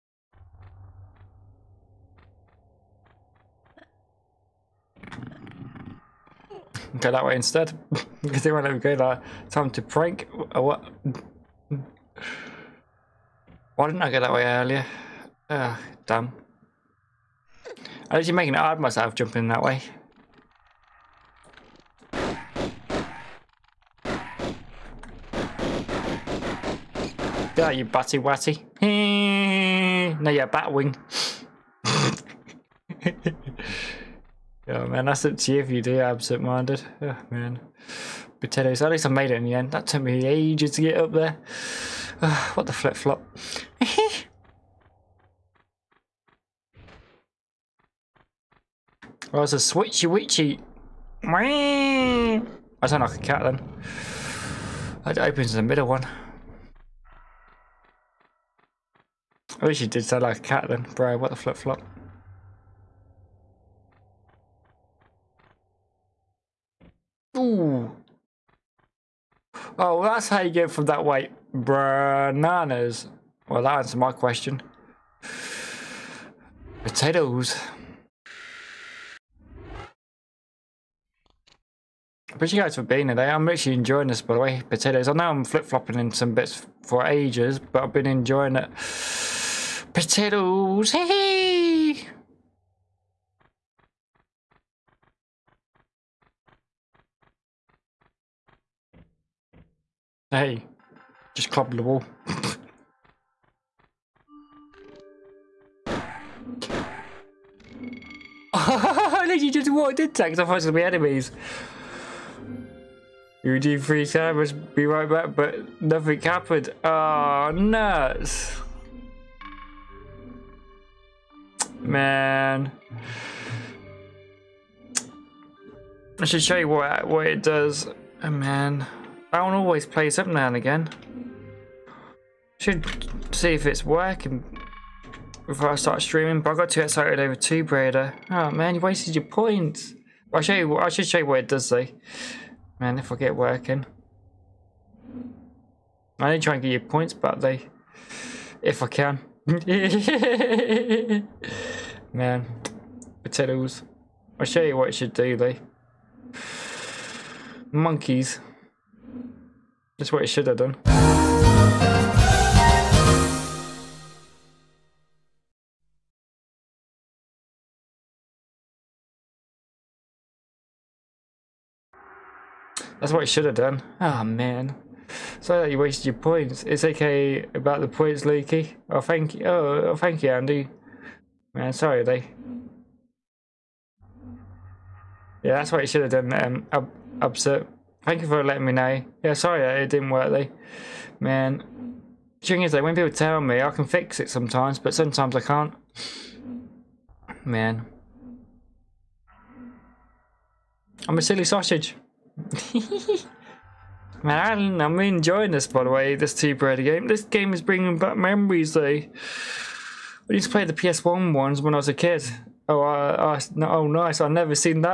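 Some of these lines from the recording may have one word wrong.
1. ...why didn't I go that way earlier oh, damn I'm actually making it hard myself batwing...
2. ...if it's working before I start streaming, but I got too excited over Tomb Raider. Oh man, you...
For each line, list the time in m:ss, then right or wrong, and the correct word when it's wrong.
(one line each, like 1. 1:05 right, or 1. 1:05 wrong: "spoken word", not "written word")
1. 0:13 wrong: "jumping", not "batwing"
2. 2:13 right.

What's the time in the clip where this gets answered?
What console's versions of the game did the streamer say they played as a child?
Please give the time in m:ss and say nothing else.
3:30.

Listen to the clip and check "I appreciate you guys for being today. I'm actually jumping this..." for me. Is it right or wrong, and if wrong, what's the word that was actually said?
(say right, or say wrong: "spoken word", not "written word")
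wrong: "enjoying", not "jumping".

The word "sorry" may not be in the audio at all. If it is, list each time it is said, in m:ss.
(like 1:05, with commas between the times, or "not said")
2:55, 3:01, 3:09.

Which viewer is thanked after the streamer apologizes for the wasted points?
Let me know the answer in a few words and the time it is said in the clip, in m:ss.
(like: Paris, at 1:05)
Andy, at 3:00.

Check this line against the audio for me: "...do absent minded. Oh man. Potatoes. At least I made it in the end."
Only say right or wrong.
right.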